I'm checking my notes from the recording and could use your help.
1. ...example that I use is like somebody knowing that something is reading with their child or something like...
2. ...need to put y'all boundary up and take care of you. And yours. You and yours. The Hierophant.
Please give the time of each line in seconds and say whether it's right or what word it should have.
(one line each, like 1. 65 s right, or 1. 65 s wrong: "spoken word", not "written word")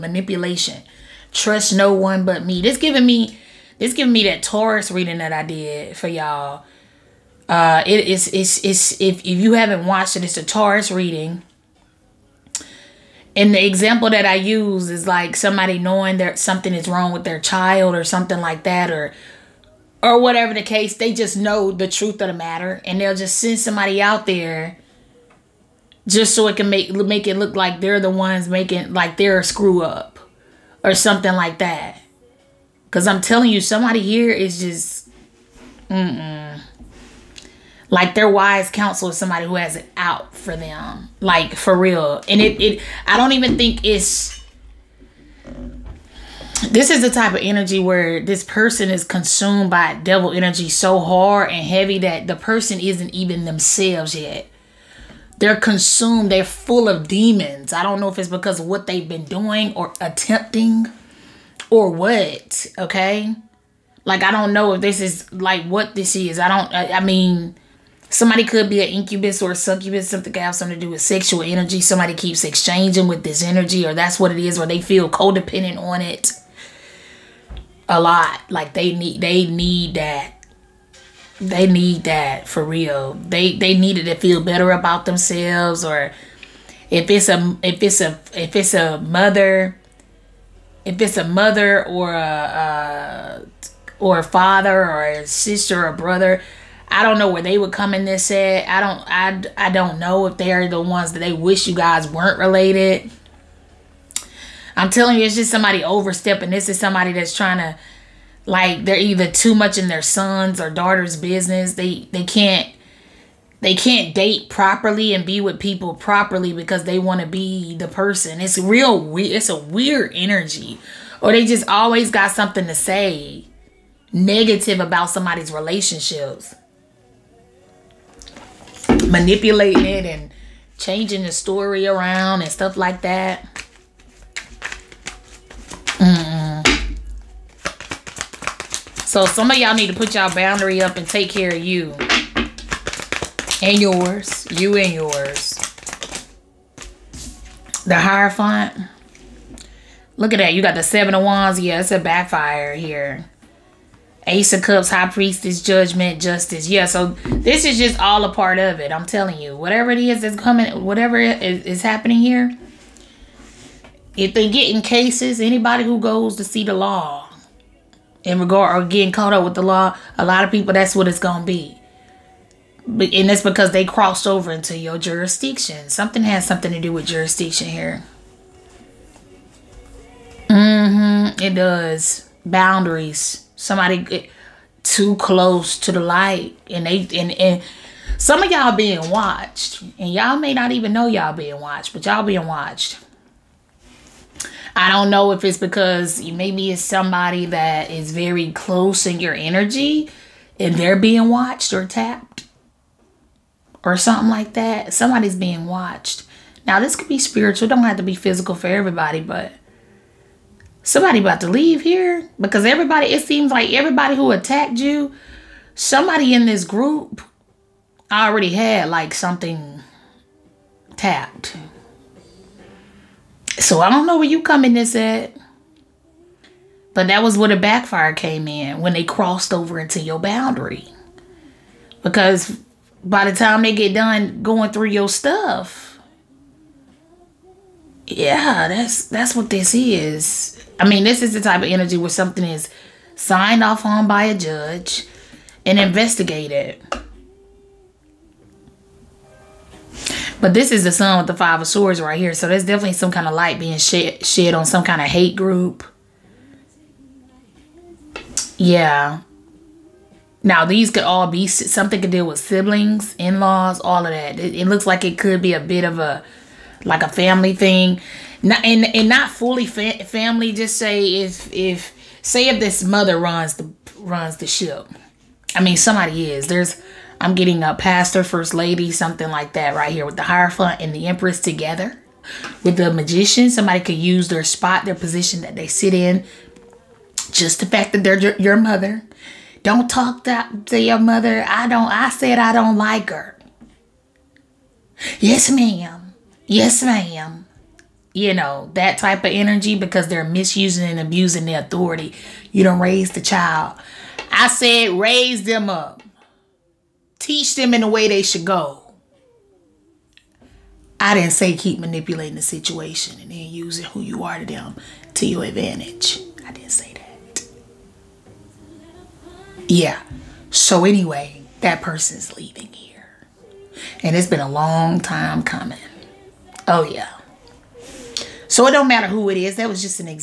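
1. 13 s wrong: "wrong", not "reading"
2. 139 s right.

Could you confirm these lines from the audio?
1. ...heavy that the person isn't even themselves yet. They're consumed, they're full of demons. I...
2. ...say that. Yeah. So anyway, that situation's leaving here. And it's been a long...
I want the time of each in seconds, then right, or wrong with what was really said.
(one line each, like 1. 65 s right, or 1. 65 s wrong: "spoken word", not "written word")
1. 51 s right
2. 316 s wrong: "person", not "situation".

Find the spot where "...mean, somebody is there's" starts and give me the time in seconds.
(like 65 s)
275 s.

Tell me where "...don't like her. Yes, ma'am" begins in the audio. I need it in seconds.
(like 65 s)
292 s.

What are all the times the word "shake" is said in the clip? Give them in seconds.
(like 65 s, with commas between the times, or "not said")
not said.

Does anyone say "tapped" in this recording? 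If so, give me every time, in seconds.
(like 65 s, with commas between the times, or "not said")
201 s, 220 s.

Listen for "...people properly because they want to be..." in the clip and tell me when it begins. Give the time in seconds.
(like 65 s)
115 s.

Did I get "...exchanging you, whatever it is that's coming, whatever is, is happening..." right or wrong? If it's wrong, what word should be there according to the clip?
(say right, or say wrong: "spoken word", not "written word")
wrong: "telling", not "exchanging".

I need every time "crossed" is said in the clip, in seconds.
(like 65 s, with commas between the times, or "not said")
173 s, 229 s.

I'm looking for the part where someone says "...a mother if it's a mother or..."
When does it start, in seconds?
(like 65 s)
88 s.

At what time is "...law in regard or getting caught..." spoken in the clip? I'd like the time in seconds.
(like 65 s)
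166 s.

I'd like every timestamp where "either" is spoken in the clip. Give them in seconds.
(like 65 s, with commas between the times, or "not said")
108 s.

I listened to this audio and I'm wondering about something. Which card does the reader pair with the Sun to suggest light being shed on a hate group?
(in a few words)
Five of Swords.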